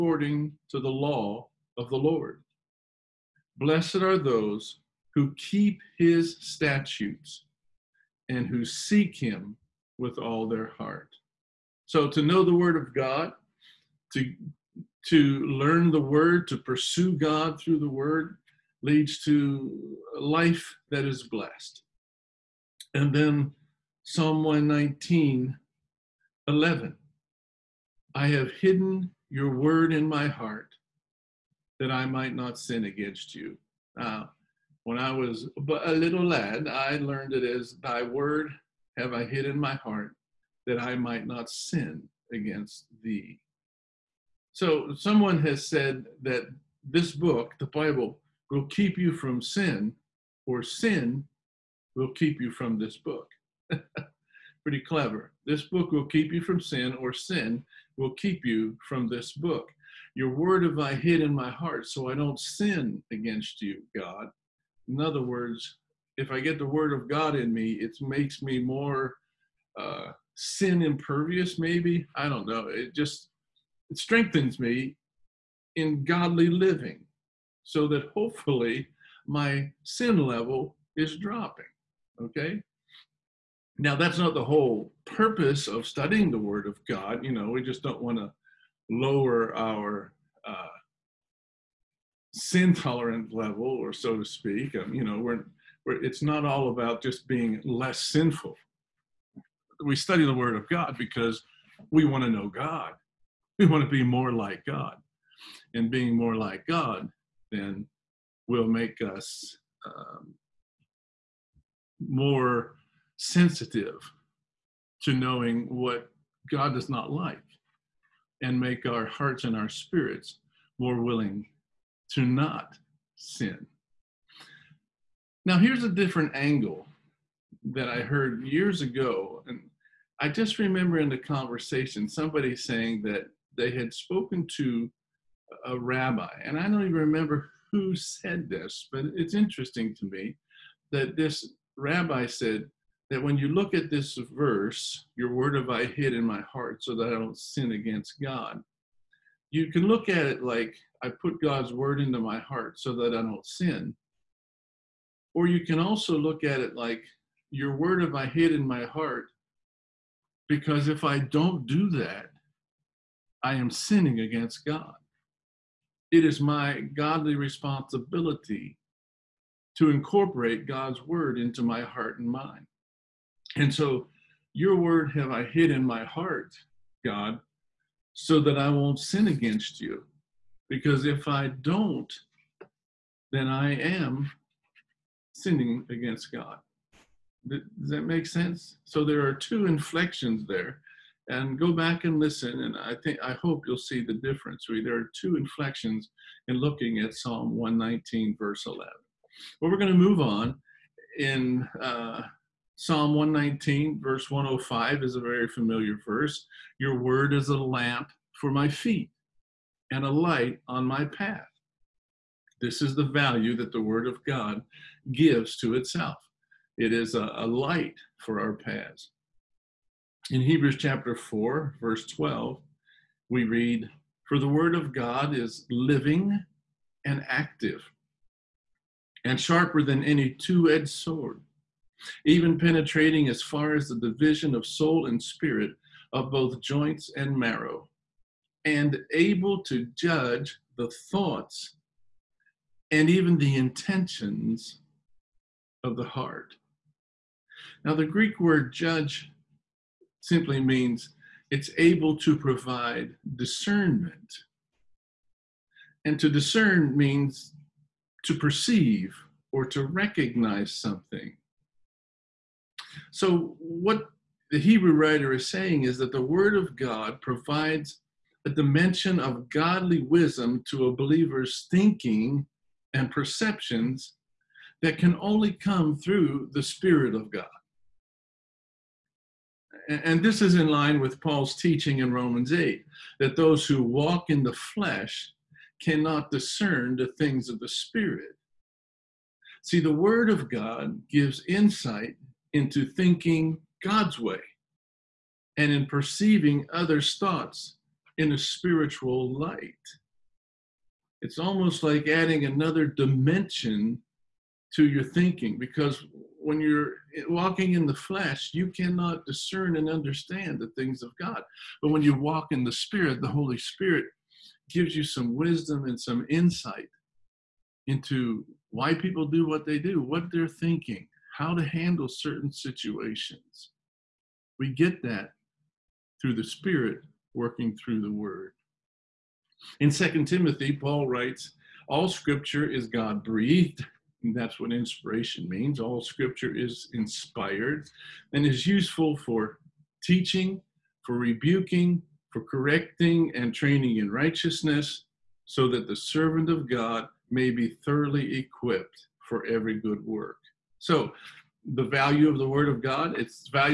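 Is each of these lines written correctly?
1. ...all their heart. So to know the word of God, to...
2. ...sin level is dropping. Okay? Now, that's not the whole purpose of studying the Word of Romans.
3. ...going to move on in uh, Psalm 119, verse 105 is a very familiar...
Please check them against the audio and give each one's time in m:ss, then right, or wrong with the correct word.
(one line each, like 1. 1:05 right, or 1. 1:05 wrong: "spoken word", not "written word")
1. 0:10 right
2. 1:19 wrong: "God", not "Romans"
3. 3:19 right.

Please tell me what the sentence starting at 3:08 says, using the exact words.
So there are two inflections there.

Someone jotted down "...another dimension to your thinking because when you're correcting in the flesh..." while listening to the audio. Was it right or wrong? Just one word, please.
wrong.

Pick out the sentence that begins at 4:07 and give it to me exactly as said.
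Now, the Greek word judge simply means it's able to provide discernment.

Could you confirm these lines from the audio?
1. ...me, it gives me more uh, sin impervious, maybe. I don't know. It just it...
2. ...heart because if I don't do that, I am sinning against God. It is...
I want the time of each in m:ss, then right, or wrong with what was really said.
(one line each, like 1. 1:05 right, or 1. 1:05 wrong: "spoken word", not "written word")
1. 1:07 wrong: "makes", not "gives"
2. 2:38 right.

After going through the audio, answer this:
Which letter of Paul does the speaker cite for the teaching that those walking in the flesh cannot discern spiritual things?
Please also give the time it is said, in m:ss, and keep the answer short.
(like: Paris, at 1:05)
Romans 8, at 4:42.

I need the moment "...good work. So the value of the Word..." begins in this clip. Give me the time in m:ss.
5:49.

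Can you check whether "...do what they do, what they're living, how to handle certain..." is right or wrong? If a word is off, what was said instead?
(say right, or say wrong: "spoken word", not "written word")
wrong: "thinking", not "living".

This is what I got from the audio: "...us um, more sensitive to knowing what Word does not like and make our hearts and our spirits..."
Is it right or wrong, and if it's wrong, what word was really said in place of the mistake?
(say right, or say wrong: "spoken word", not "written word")
wrong: "God", not "Word".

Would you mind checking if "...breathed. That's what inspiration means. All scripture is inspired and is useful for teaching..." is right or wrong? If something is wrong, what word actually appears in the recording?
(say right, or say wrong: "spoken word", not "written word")
right.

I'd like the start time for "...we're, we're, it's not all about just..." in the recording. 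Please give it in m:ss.
1:35.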